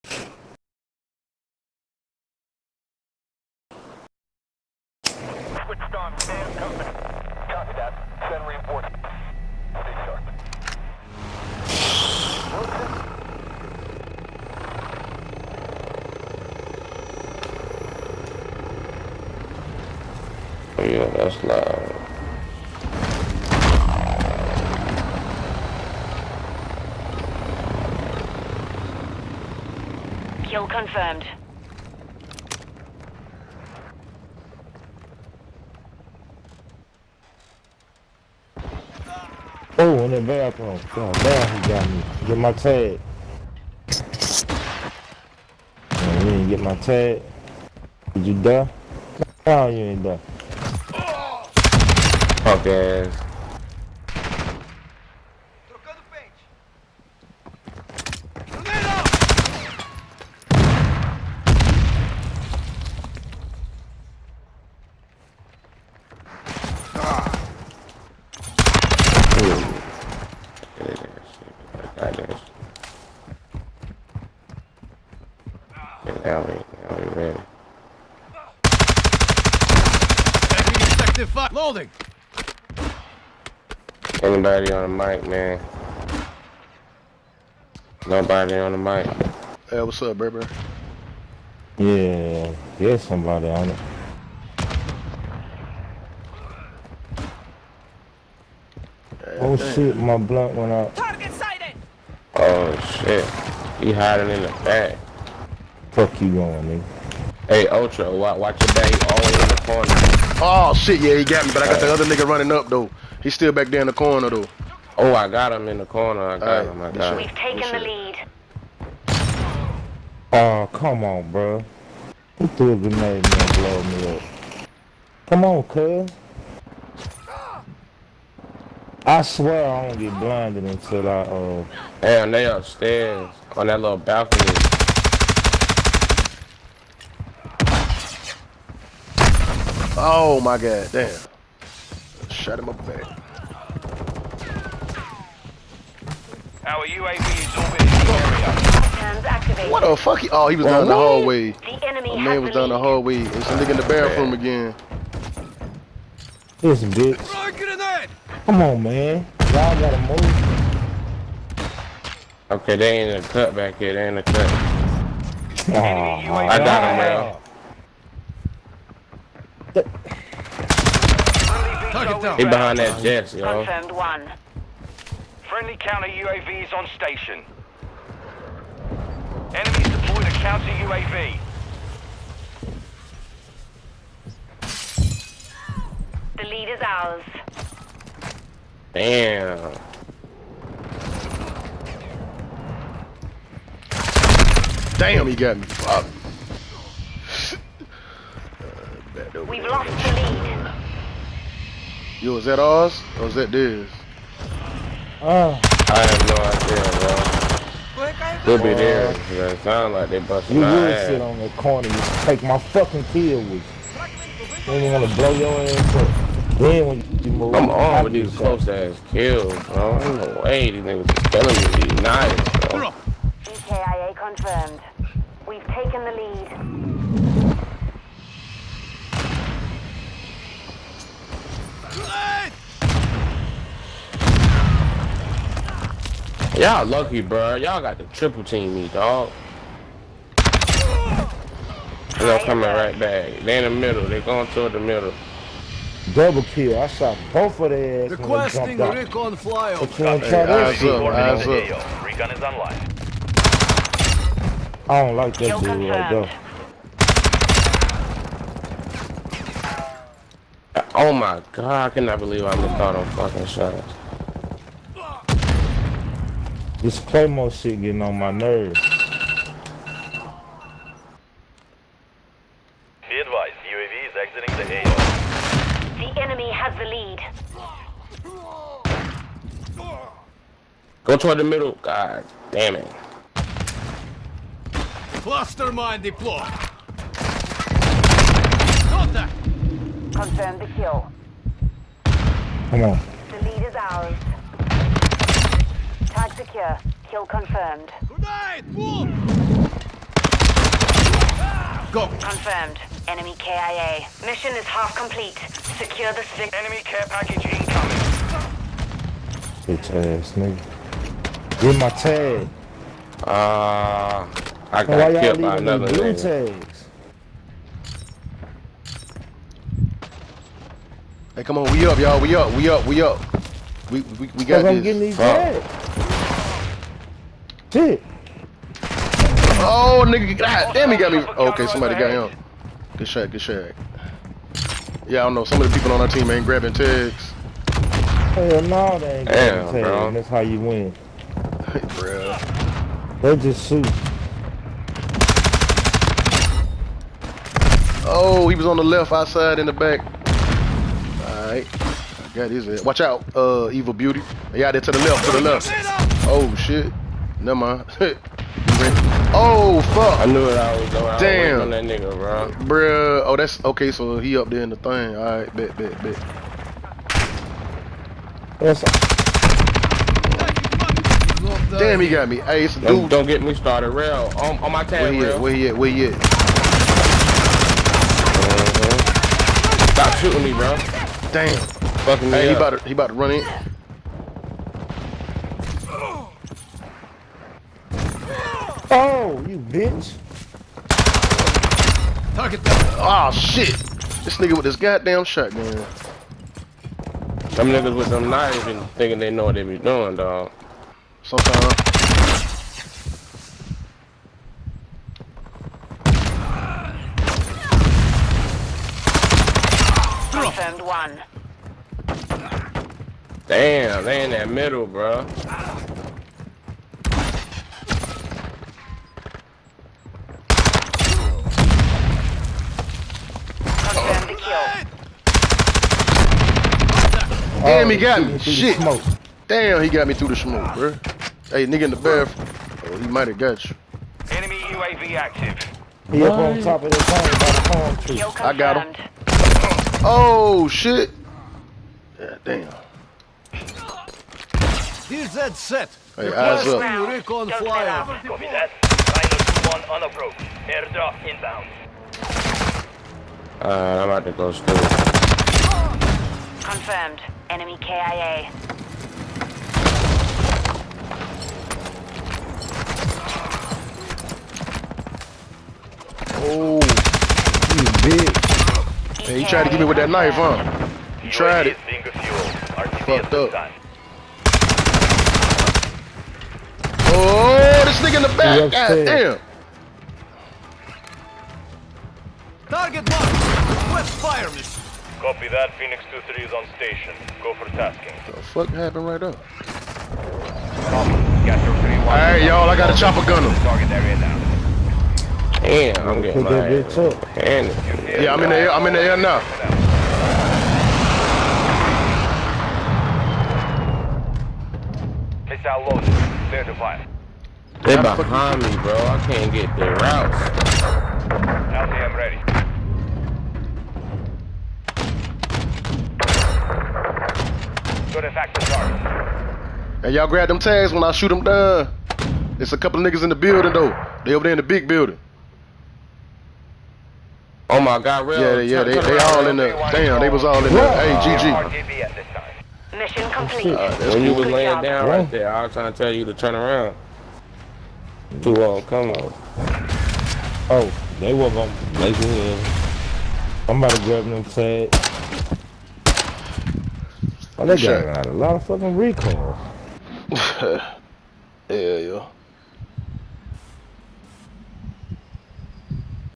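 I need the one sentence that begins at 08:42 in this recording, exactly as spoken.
It's a couple niggas in the building though.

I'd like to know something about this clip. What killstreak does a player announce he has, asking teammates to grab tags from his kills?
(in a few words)
Chopper gunner.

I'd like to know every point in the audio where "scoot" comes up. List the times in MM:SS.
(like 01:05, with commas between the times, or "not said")
not said.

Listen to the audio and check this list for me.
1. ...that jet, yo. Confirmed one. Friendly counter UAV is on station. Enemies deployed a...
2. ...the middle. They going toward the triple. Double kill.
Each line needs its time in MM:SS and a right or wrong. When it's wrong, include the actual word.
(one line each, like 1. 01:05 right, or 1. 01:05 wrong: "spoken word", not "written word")
1. 02:52 right
2. 04:03 wrong: "middle", not "triple".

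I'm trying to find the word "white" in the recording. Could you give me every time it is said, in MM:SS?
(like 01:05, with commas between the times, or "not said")
not said.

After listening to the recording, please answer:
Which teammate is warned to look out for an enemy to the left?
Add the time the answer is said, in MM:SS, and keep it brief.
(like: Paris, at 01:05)
Evil Beauty, at 05:53.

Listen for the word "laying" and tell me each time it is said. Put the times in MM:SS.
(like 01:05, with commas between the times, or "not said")
08:54.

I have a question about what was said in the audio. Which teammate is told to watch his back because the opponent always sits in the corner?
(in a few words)
Ultra.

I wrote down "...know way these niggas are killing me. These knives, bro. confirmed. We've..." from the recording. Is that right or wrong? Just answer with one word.
right.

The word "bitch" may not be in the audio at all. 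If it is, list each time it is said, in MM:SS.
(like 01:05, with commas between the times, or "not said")
02:36, 05:09, 06:29, 07:48.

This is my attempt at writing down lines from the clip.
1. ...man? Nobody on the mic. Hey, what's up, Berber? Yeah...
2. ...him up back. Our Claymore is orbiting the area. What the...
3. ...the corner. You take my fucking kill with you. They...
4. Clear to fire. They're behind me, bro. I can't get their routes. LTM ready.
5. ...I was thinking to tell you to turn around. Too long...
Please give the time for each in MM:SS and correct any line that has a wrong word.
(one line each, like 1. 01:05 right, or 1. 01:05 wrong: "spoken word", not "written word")
1. 01:25 right
2. 02:22 wrong: "UAV", not "Claymore"
3. 03:31 right
4. 08:26 right
5. 08:55 wrong: "trying", not "thinking".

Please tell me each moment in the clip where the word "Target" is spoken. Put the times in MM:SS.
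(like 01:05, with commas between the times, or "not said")
01:40, 06:32, 08:02, 08:13.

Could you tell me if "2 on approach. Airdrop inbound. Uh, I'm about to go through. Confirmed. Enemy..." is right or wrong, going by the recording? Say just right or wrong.
wrong.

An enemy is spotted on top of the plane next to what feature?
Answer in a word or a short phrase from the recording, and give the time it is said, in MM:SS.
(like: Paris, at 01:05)
Palm tree, at 07:17.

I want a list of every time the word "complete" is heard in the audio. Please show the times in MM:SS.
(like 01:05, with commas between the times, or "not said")
05:04, 08:53.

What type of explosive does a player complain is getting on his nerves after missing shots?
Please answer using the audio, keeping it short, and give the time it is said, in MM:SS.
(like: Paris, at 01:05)
Claymore, at 04:26.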